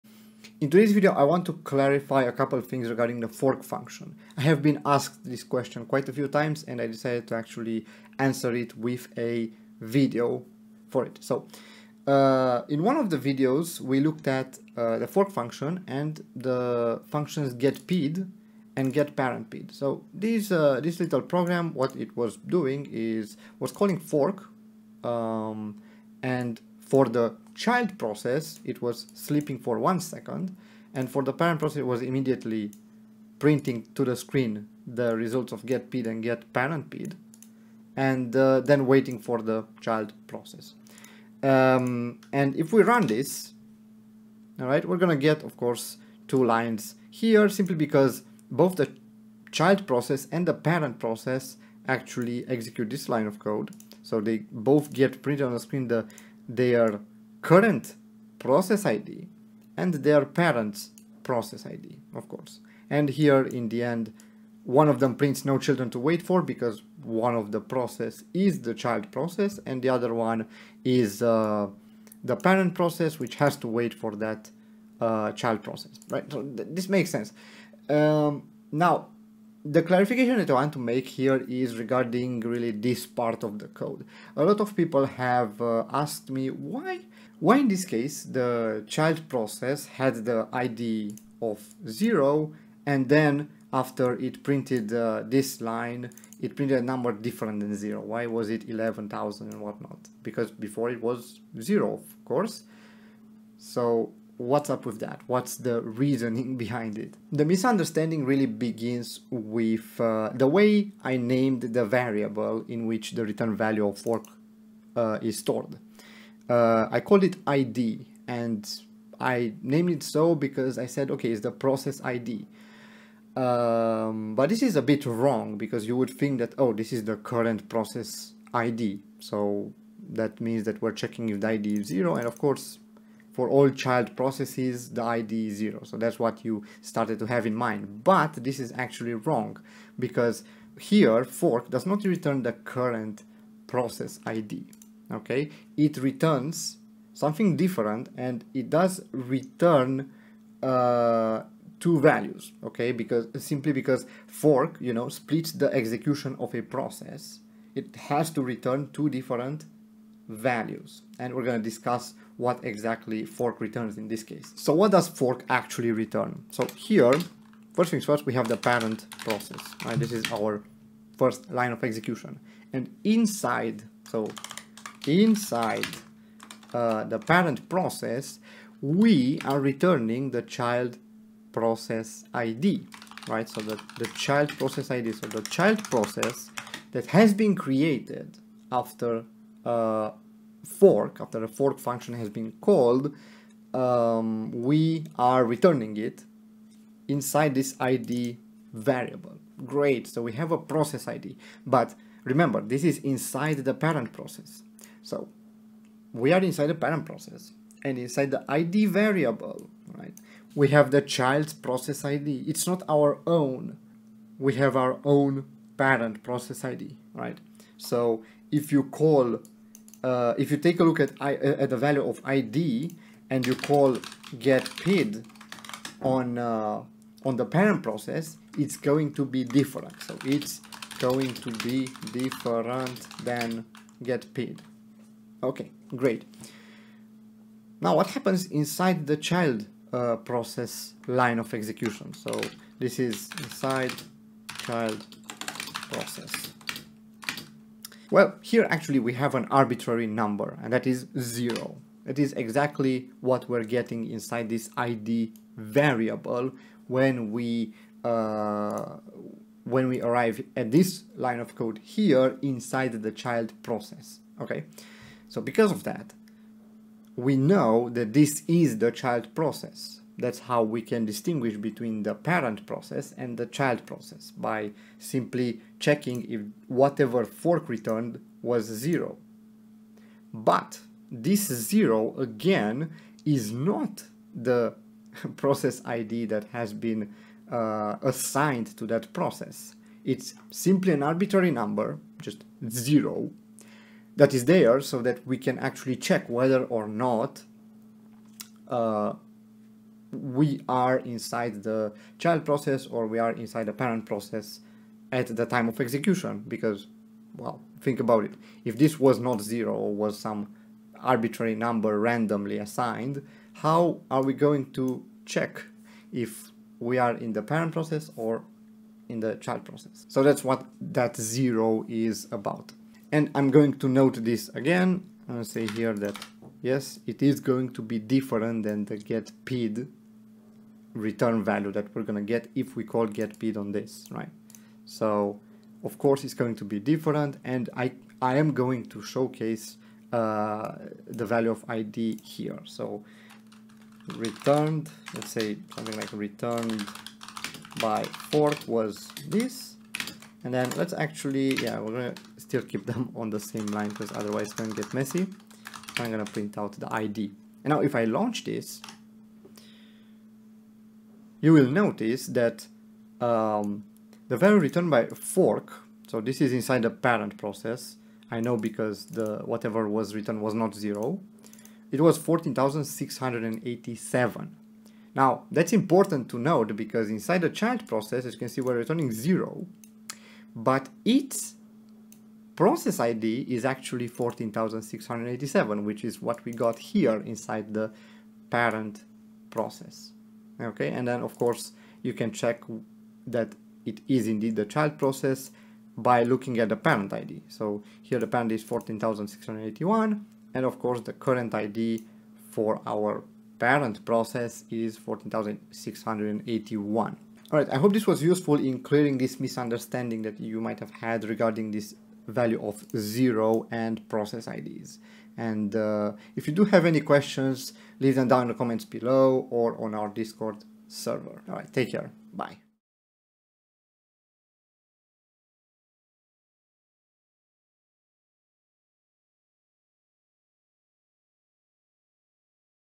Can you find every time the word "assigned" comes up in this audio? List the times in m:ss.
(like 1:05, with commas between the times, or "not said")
4:48, 5:12.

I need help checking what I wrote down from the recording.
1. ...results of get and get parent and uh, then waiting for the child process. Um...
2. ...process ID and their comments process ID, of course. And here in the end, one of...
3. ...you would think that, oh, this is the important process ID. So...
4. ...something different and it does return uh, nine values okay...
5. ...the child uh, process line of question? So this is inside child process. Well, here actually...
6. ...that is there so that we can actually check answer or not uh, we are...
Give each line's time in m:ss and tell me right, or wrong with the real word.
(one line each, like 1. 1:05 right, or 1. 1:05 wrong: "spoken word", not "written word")
1. 0:35 right
2. 0:58 wrong: "parents", not "comments"
3. 2:05 wrong: "current", not "important"
4. 2:27 wrong: "two", not "nine"
5. 3:59 wrong: "execution", not "question"
6. 4:54 wrong: "whether", not "answer".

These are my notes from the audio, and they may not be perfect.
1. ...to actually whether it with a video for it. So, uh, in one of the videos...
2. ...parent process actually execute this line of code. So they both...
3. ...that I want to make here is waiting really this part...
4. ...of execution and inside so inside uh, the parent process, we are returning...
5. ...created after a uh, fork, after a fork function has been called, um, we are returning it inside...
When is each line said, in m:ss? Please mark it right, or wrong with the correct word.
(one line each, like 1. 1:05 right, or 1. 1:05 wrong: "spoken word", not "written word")
1. 0:07 wrong: "answer", not "whether"
2. 0:50 right
3. 1:20 wrong: "regarding", not "waiting"
4. 2:51 right
5. 3:07 right.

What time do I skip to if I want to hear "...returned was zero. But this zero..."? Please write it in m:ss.
4:37.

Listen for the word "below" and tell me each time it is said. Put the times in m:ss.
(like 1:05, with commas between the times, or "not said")
6:58.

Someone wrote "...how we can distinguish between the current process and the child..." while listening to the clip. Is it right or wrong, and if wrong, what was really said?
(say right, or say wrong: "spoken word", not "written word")
wrong: "parent", not "current".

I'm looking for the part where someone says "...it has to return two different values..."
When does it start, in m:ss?
2:37.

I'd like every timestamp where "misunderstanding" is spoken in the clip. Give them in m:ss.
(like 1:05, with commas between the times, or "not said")
1:47, 6:49.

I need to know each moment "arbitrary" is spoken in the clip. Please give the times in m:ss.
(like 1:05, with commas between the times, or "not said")
4:09, 4:51, 5:10.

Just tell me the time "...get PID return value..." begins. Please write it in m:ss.
5:28.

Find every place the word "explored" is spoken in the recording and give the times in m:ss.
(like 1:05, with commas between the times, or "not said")
not said.